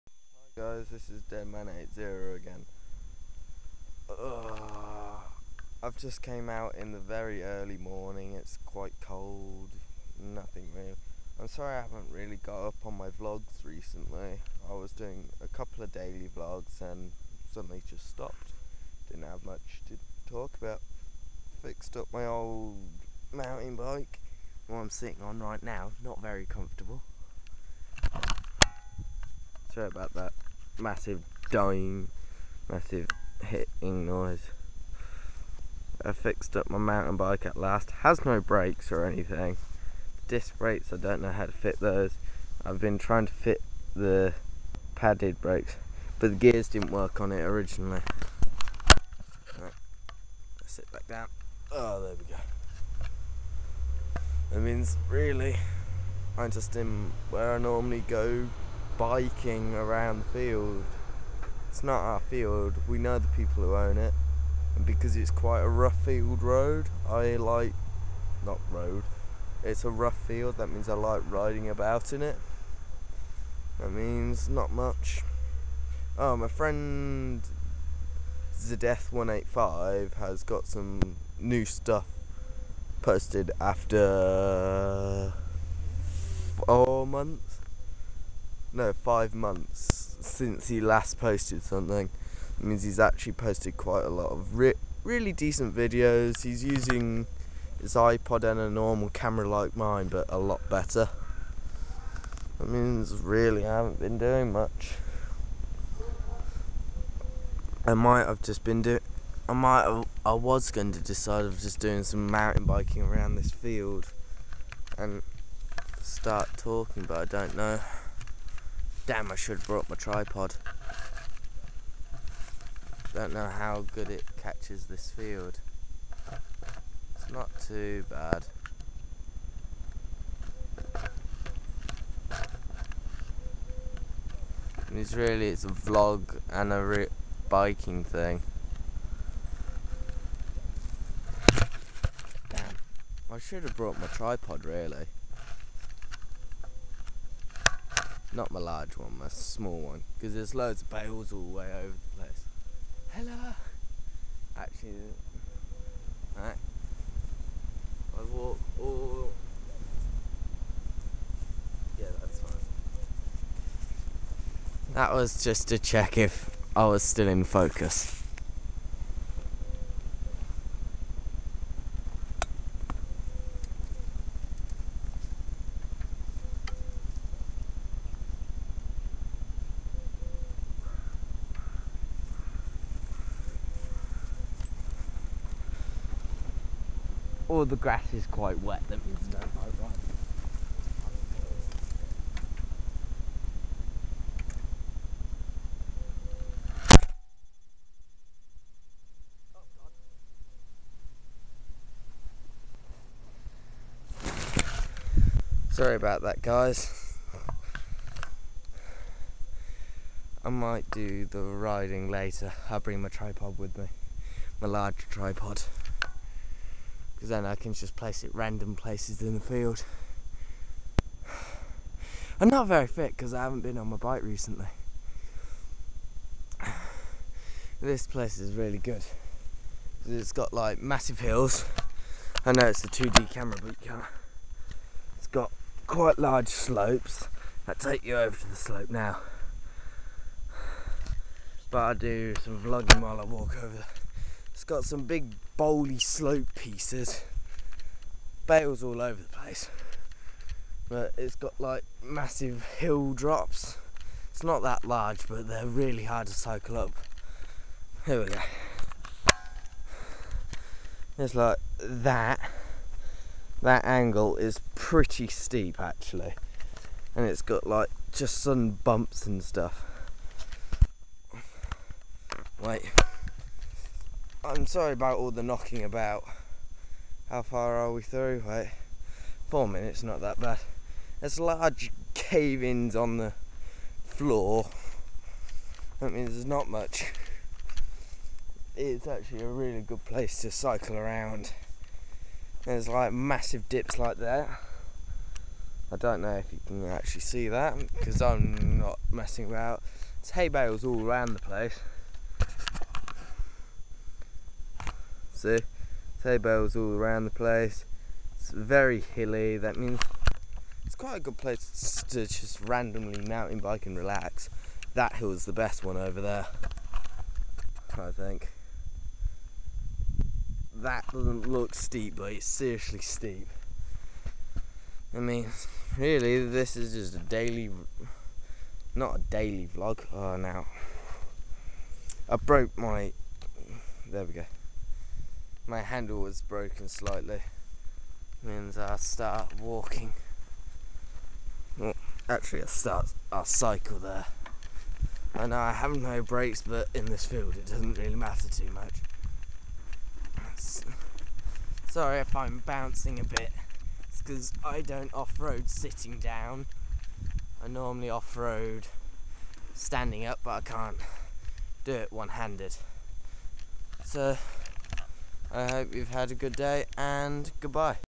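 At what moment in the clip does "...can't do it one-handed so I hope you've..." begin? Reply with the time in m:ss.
6:00.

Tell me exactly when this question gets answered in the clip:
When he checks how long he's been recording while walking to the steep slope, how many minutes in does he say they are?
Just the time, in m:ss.
4:39.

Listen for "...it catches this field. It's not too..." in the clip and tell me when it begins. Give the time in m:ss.
2:04.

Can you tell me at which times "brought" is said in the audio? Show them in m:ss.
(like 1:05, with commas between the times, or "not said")
1:59, 2:23.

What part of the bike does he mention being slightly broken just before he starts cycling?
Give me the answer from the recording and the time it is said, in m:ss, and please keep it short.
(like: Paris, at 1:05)
handle, at 5:35.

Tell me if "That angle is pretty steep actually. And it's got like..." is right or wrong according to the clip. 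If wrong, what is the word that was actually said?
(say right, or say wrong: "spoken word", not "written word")
right.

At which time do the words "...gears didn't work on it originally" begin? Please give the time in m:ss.
0:46.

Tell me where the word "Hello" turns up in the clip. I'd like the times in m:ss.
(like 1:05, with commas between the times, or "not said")
2:33.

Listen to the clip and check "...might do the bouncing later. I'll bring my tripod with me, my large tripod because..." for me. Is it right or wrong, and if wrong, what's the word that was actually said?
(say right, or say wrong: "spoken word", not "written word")
wrong: "riding", not "bouncing".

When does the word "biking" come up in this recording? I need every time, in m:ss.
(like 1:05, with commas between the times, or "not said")
0:58, 1:52, 2:17.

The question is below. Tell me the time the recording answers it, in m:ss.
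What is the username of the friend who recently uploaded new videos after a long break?
1:18.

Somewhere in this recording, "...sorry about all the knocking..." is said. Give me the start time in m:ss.
4:34.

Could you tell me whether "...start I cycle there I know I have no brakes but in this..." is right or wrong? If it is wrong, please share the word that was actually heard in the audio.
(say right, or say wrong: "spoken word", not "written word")
right.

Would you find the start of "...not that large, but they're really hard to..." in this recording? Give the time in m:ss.
4:14.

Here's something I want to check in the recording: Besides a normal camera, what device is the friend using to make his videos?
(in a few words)
iPod.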